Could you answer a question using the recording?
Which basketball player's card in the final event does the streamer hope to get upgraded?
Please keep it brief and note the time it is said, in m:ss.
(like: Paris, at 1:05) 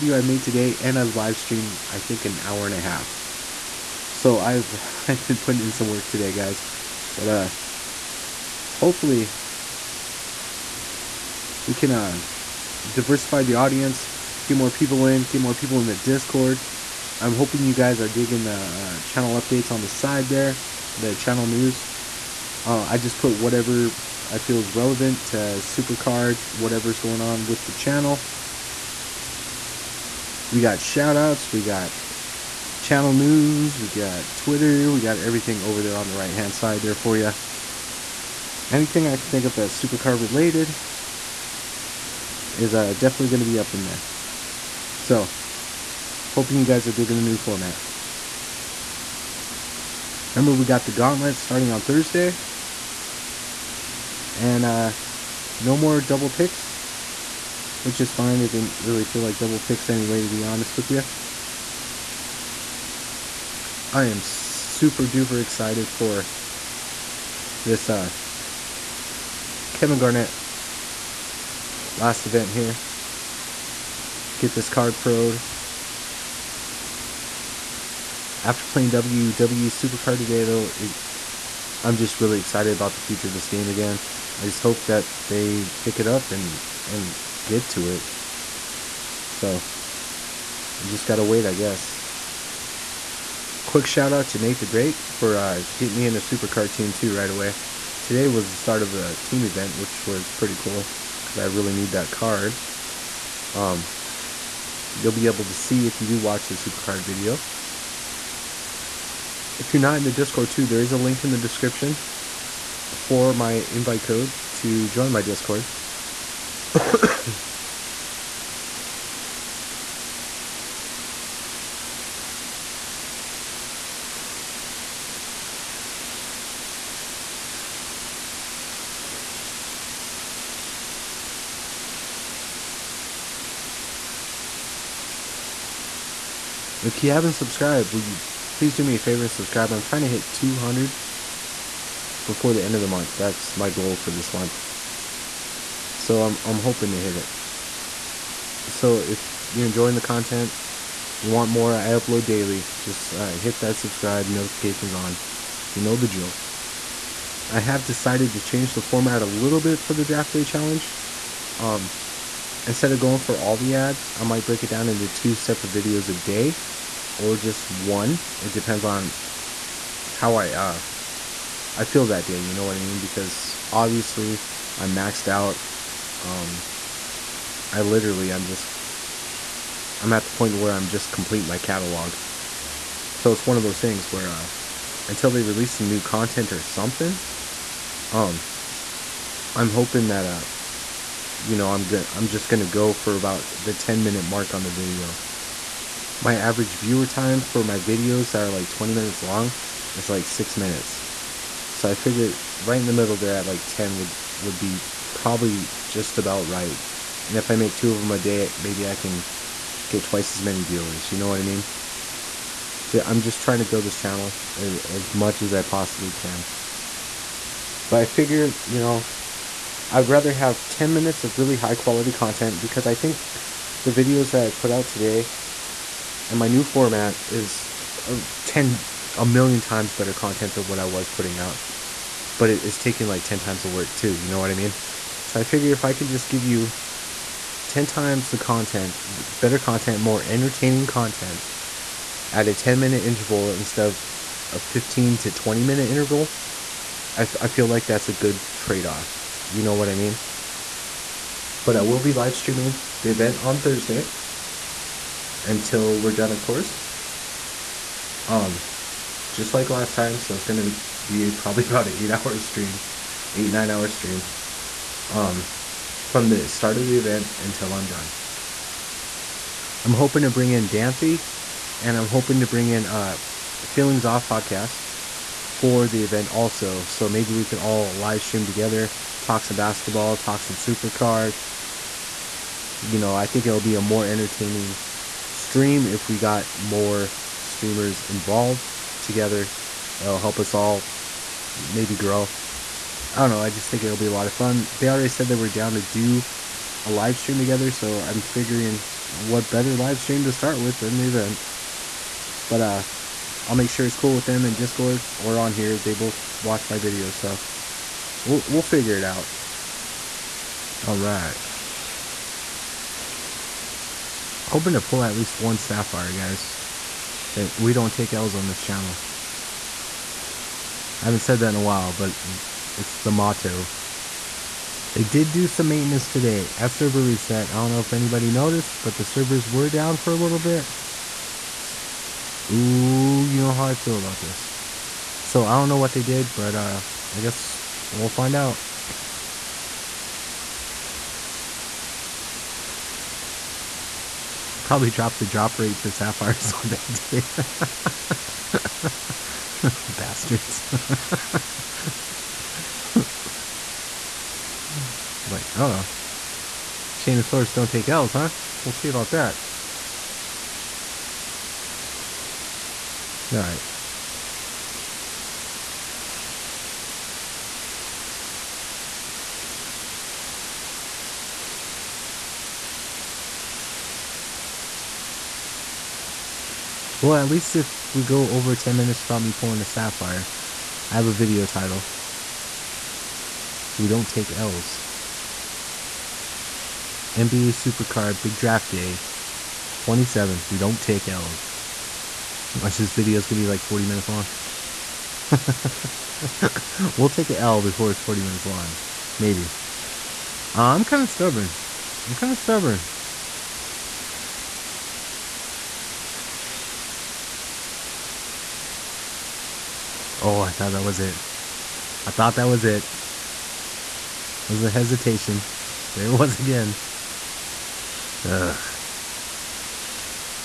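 Kevin Garnett, at 1:09.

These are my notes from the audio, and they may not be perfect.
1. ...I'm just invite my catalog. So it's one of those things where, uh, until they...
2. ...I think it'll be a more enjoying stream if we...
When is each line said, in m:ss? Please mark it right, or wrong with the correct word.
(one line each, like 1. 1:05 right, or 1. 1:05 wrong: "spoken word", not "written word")
1. 3:00 wrong: "complete", not "invite"
2. 4:43 wrong: "entertaining", not "enjoying".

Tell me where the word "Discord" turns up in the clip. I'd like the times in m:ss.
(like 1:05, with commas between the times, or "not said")
0:15, 1:50, 1:55, 5:04.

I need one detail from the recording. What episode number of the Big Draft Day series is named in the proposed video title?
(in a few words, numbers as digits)
27.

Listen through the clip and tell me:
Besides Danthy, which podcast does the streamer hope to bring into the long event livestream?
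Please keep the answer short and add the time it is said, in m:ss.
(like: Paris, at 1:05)
Feelings Off podcast, at 4:33.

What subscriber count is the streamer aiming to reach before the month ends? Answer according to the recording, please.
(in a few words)
200.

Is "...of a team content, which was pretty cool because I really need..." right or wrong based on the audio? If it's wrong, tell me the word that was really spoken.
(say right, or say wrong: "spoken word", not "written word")
wrong: "event", not "content".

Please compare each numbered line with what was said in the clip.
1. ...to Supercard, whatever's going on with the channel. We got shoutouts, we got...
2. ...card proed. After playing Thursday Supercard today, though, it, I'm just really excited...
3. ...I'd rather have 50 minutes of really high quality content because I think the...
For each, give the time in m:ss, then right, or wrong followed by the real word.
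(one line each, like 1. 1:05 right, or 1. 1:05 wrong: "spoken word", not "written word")
1. 0:25 right
2. 1:14 wrong: "WWE", not "Thursday"
3. 3:39 wrong: "10", not "50".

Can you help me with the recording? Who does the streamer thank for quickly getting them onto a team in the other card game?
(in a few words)
Nate the Great.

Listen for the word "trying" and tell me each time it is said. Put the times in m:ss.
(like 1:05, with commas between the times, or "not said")
2:19, 3:33.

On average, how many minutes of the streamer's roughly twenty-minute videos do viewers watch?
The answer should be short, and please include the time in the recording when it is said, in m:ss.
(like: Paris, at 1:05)
6 minutes, at 3:20.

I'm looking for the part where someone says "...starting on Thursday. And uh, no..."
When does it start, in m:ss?
0:51.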